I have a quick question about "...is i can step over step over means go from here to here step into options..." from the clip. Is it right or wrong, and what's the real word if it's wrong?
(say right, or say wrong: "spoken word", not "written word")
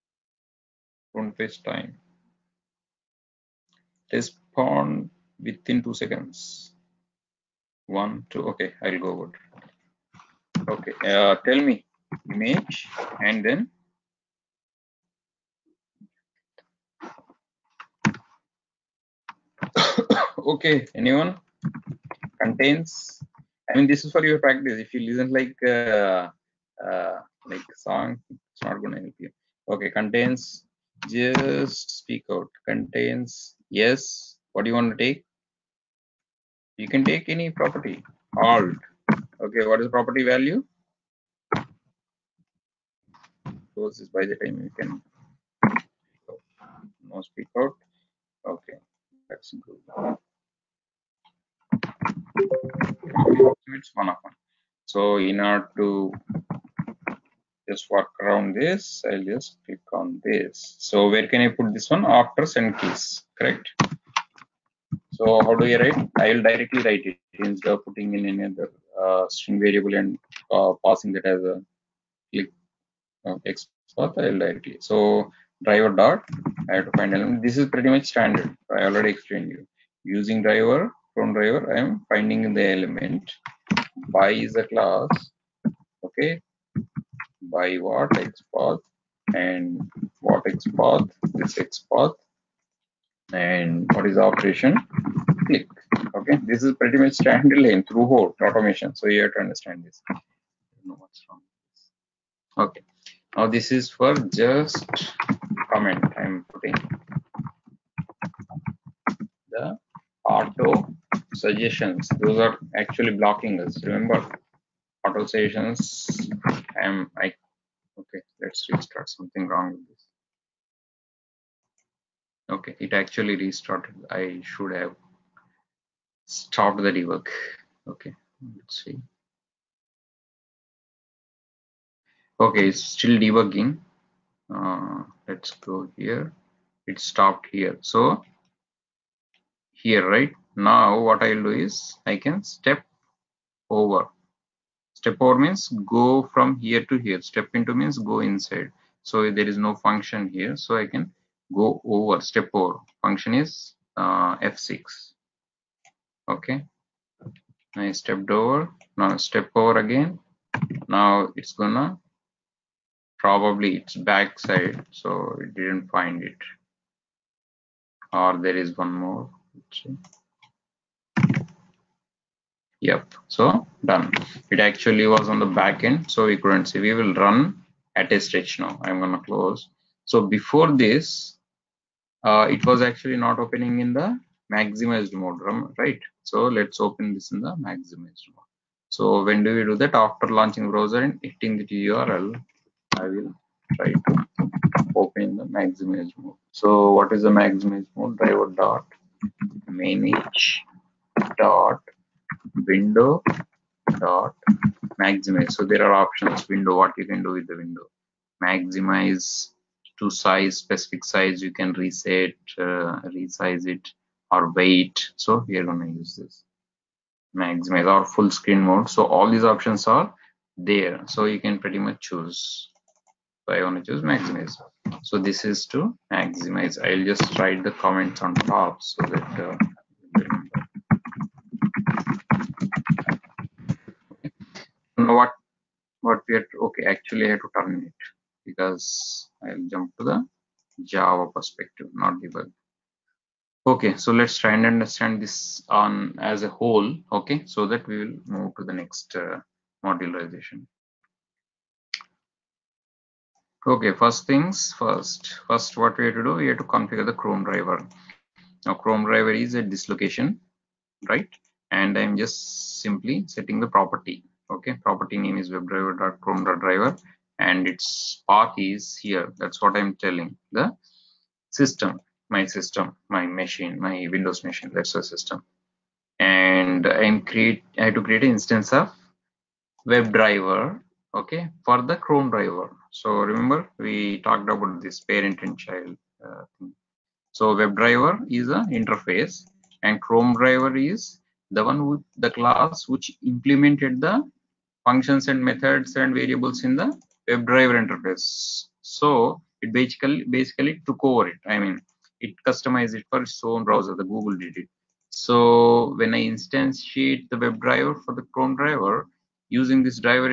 wrong: "means", not "options".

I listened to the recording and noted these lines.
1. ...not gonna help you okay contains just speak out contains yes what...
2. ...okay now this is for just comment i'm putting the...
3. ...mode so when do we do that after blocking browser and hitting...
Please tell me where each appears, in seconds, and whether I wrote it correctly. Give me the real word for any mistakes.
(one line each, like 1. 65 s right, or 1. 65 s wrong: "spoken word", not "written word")
1. 28 s right
2. 102 s right
3. 188 s wrong: "launching", not "blocking".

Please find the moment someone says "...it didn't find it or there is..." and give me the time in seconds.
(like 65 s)
165 s.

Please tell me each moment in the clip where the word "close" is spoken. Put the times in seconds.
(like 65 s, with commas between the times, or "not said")
43 s, 179 s.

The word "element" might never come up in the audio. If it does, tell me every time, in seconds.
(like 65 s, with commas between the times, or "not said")
77 s, 82 s.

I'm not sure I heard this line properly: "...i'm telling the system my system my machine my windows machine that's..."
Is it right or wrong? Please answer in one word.
right.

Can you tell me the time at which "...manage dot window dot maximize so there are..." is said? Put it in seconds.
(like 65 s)
199 s.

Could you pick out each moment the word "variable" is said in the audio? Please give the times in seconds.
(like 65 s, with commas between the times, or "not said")
69 s, 296 s.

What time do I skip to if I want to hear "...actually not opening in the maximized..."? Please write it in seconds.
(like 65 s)
182 s.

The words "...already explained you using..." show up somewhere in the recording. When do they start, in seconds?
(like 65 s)
78 s.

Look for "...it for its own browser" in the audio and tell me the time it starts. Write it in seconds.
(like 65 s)
302 s.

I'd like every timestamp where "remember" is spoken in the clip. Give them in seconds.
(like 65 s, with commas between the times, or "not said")
113 s, 283 s.